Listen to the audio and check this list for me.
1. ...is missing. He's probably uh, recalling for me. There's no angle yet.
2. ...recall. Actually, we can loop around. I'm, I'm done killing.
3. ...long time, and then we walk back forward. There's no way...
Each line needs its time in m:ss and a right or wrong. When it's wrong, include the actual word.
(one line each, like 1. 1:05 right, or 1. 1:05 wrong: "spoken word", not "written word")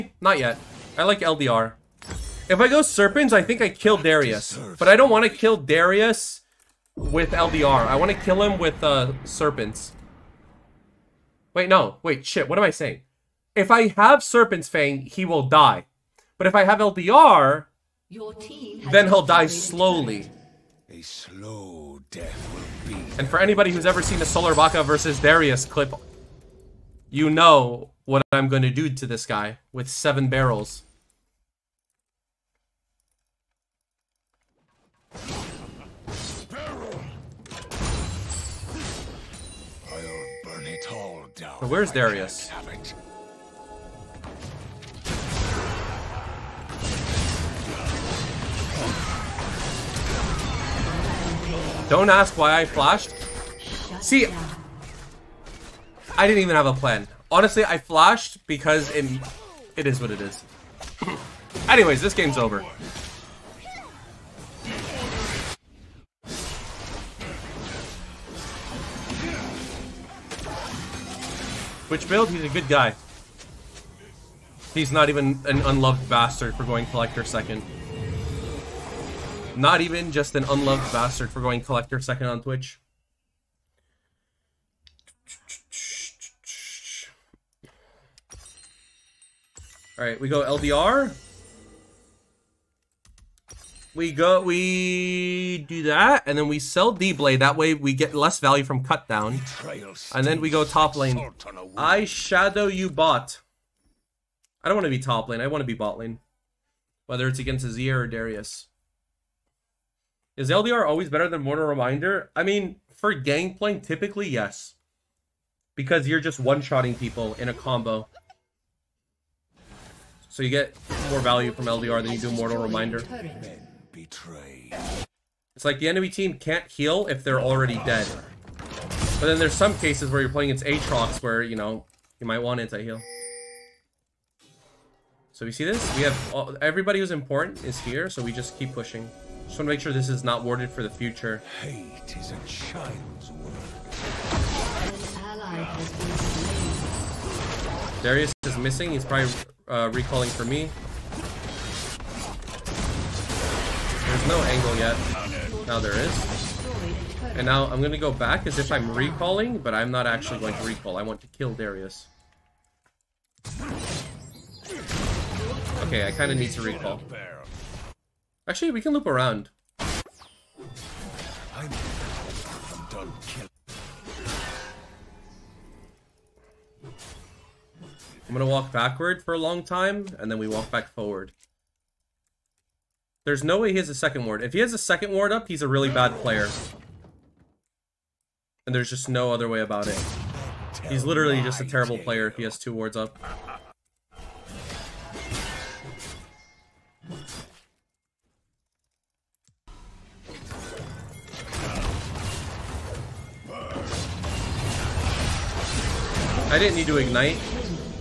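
1. 2:28 right
2. 2:46 right
3. 2:59 right.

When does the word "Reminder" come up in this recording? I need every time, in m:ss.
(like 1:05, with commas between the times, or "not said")
1:51, 2:02.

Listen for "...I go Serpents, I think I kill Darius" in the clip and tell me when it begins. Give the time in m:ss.
0:02.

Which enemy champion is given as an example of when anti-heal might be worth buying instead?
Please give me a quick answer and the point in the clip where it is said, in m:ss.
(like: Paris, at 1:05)
Aatrox, at 2:10.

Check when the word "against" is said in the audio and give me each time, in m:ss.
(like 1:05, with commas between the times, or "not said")
1:47, 2:10.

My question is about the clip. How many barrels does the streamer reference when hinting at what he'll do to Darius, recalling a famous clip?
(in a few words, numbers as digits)
7.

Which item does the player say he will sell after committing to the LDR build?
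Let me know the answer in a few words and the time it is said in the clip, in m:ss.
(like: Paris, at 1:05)
D-Blade, at 1:36.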